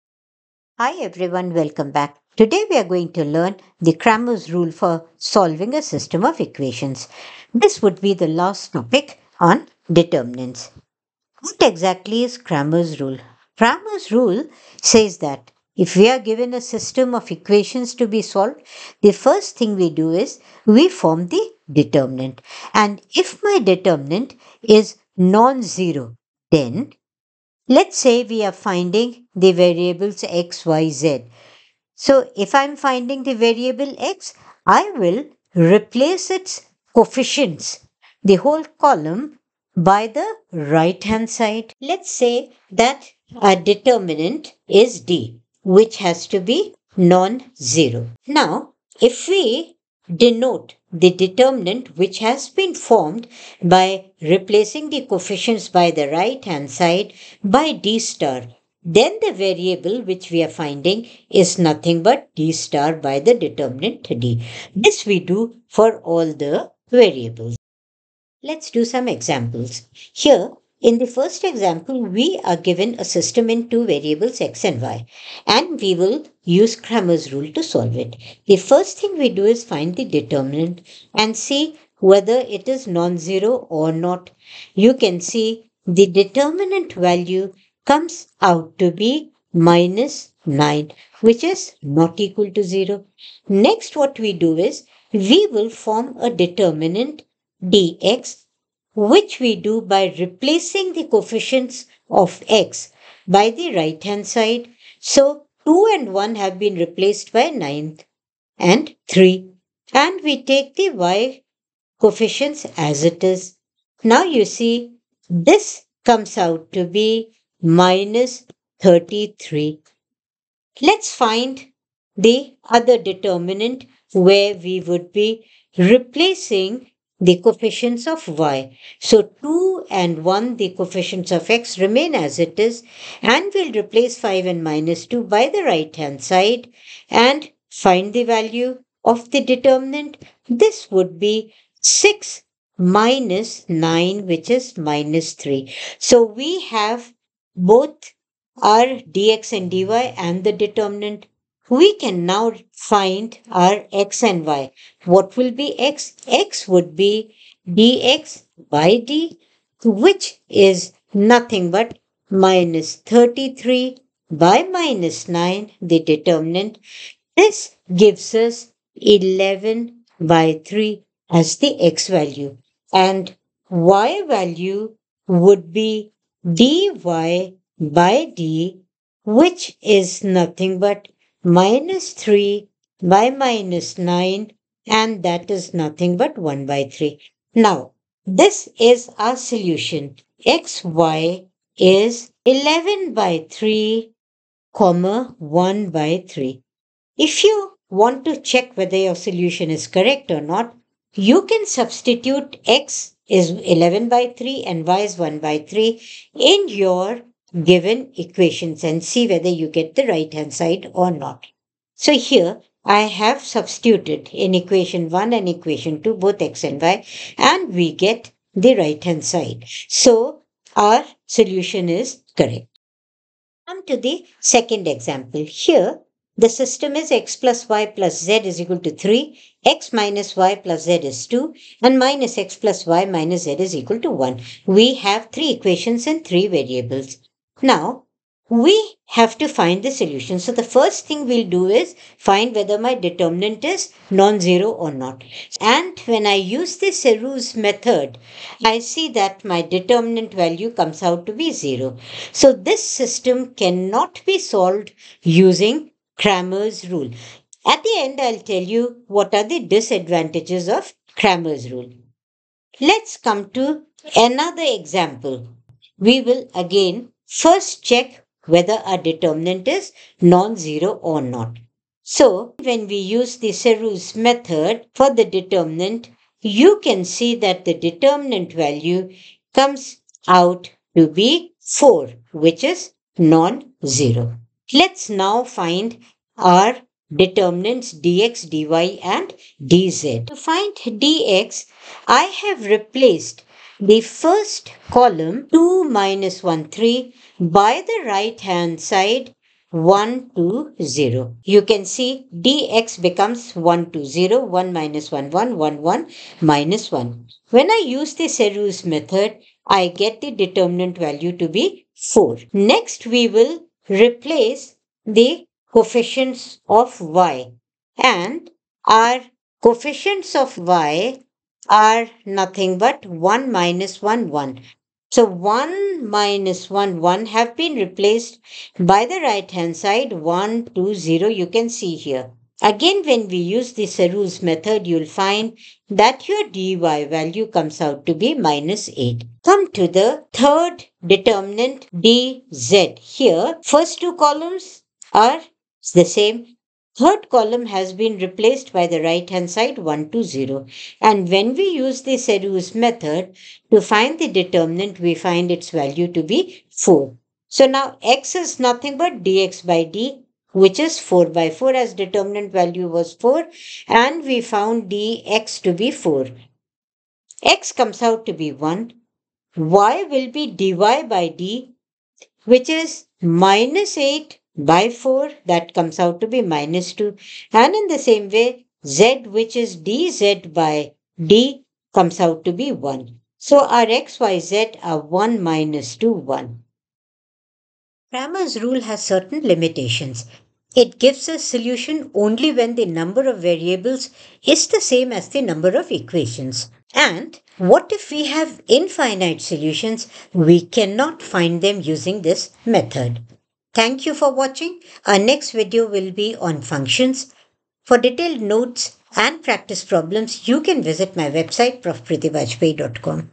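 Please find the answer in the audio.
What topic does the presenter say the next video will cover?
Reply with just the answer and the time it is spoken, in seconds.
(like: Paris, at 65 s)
Functions, at 406 s.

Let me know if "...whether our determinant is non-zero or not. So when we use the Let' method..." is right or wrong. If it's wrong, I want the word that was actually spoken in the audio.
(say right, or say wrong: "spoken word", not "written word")
wrong: "Sarrus", not "Let".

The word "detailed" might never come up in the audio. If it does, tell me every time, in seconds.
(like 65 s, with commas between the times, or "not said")
407 s.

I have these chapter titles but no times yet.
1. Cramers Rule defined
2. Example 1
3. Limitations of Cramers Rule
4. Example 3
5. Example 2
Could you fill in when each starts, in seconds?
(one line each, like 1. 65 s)
1. 12 s
2. 69 s
3. 388 s
4. 264 s
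5. 222 s.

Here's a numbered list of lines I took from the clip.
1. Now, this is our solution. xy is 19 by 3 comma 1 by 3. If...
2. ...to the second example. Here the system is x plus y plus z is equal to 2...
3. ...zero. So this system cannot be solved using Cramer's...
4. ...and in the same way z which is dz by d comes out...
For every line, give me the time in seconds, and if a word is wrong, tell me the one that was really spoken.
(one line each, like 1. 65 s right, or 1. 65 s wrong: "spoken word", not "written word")
1. 187 s wrong: "11", not "19"
2. 223 s wrong: "3", not "2"
3. 251 s right
4. 377 s right.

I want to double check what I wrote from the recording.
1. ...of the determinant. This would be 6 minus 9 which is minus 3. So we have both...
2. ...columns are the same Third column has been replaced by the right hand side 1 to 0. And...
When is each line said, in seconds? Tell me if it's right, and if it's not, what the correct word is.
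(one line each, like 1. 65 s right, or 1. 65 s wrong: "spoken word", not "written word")
1. 139 s right
2. 344 s right.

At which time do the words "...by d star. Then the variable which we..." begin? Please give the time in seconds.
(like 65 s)
57 s.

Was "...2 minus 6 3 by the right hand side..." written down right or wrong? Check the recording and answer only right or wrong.
wrong.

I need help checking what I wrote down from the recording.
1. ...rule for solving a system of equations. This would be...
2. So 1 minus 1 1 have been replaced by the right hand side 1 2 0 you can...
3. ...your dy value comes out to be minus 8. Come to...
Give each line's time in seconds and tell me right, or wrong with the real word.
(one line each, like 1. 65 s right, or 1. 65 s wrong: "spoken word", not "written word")
1. 4 s right
2. 325 s right
3. 336 s right.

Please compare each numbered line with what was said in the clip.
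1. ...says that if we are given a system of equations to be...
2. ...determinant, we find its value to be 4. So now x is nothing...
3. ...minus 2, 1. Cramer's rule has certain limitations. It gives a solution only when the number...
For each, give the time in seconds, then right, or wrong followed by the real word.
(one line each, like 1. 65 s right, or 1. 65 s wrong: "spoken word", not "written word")
1. 14 s right
2. 354 s right
3. 385 s right.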